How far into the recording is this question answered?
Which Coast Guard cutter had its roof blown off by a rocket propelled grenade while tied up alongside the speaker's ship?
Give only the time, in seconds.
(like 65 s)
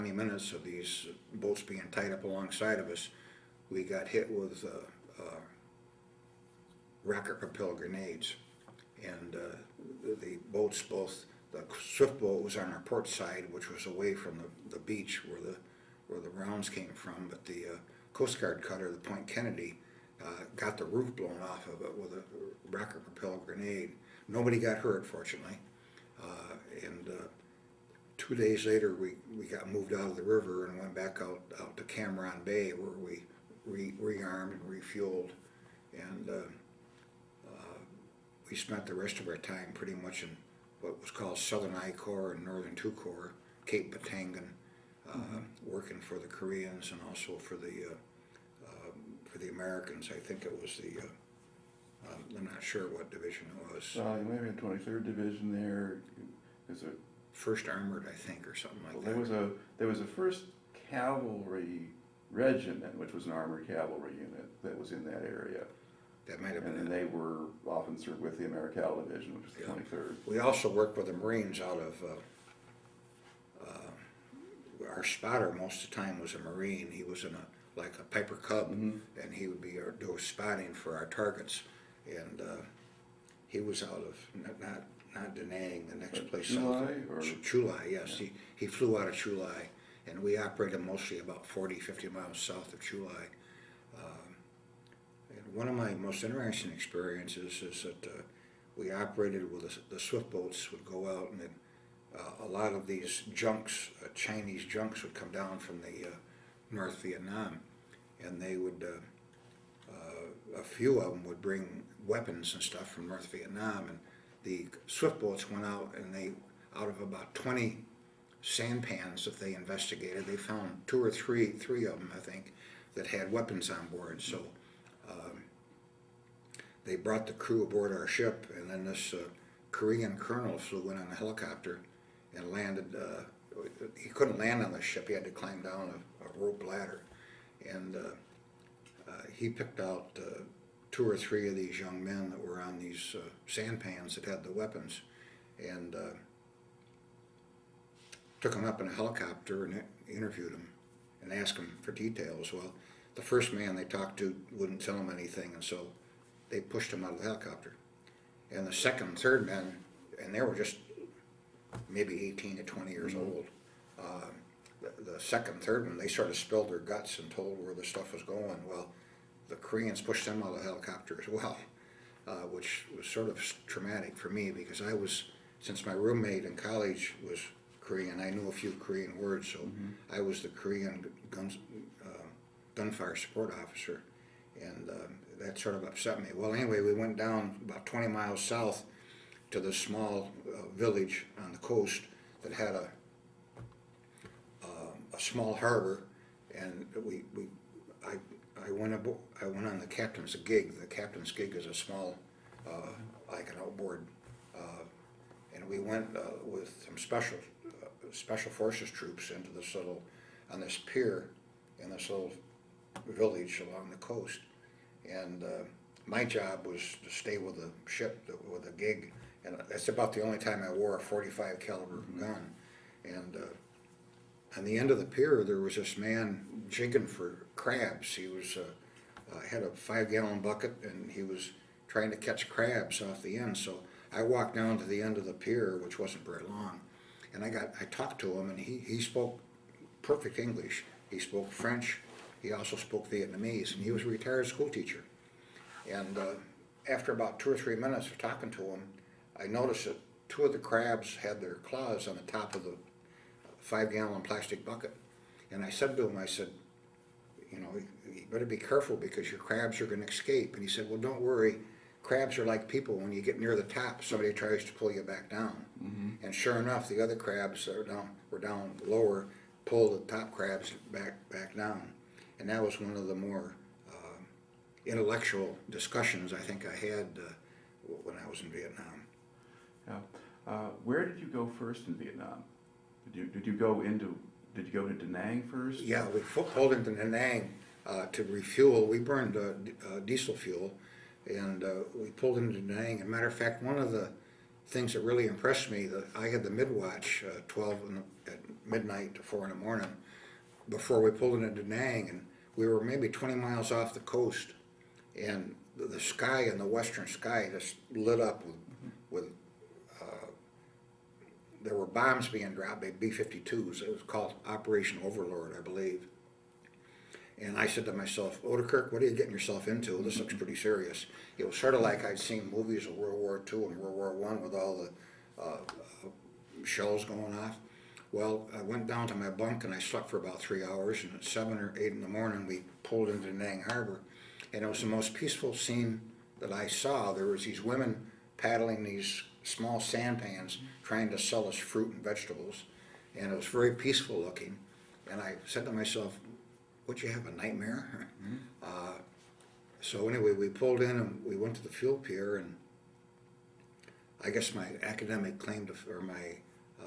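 18 s.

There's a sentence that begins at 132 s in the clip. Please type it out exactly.
Uh, he couldn't land on the ship; he had to climb down rope ladder.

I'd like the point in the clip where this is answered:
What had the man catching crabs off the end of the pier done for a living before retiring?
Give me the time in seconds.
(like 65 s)
244 s.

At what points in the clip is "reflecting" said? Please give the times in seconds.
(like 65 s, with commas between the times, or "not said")
not said.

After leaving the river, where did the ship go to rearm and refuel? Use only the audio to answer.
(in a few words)
Cam Ranh Bay.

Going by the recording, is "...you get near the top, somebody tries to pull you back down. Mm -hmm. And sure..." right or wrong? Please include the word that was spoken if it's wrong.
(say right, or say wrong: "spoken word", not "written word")
right.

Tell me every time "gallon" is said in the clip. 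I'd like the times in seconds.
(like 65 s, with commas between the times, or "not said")
229 s, 253 s.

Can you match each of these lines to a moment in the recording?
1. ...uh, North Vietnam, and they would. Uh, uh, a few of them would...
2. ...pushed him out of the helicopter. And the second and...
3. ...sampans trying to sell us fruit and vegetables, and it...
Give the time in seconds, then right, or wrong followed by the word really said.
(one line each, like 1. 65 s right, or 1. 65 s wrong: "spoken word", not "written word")
1. 106 s right
2. 156 s right
3. 339 s right.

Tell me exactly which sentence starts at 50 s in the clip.
I think it was the, uh, um, I'm not sure what division it was.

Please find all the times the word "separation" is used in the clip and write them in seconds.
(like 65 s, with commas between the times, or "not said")
not said.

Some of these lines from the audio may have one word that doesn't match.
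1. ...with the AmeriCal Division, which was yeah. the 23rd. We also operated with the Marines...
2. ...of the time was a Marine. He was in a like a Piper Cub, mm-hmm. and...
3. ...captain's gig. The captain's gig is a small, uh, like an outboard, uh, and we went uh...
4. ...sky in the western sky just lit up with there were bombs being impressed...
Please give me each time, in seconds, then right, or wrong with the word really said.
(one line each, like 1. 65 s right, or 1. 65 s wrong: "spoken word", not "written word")
1. 68 s wrong: "worked", not "operated"
2. 75 s right
3. 199 s right
4. 306 s wrong: "dropped", not "impressed".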